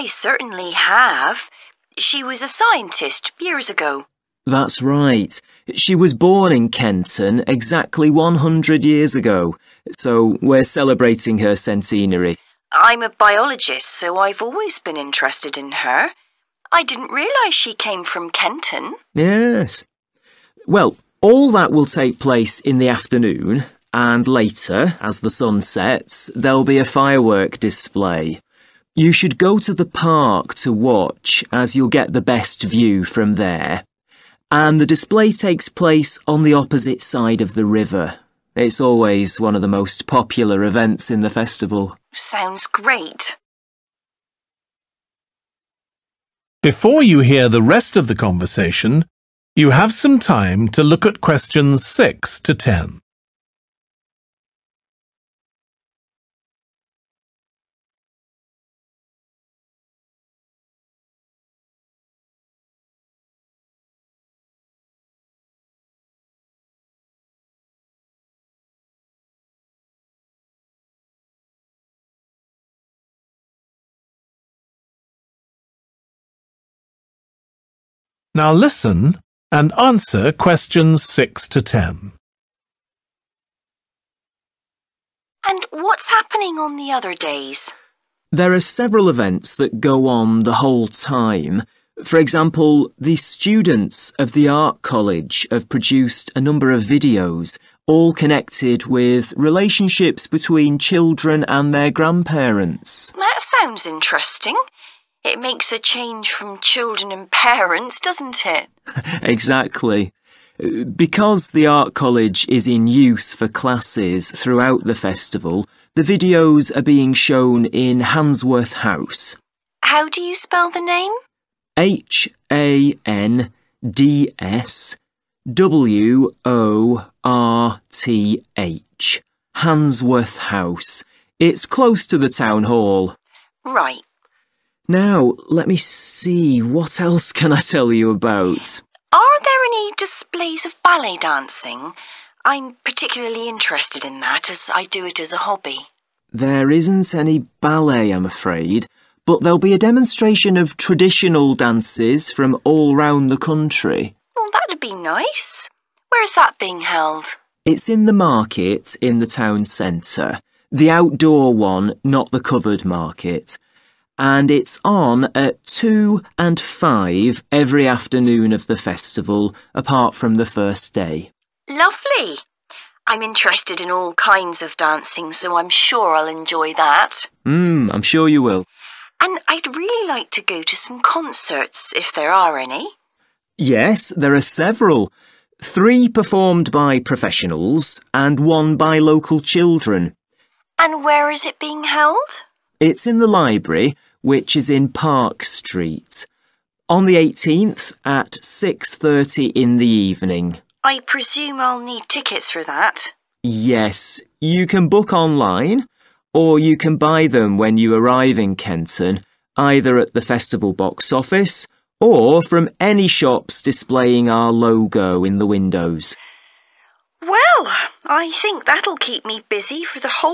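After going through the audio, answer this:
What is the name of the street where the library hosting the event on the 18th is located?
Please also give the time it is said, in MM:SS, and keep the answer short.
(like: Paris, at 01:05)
Park Street, at 03:14.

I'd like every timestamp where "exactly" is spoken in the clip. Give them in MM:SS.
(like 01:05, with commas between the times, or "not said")
00:07, 01:49.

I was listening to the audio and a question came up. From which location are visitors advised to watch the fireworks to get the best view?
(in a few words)
the park.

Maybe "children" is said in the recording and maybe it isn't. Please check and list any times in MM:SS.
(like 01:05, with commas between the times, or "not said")
01:40, 01:46, 03:09.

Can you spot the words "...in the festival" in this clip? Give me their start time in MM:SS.
00:41.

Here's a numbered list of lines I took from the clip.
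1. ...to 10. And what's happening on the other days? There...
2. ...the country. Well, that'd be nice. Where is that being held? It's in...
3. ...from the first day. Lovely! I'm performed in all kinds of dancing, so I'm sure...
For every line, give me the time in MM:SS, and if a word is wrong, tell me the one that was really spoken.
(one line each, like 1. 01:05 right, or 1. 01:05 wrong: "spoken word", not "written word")
1. 01:21 right
2. 02:33 right
3. 02:50 wrong: "interested", not "performed".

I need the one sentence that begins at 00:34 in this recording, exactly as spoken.
And the display takes place on the opposite side of the river.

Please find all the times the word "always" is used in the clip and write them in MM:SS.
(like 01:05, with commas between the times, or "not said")
00:14, 00:38.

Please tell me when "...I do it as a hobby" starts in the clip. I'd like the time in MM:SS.
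02:24.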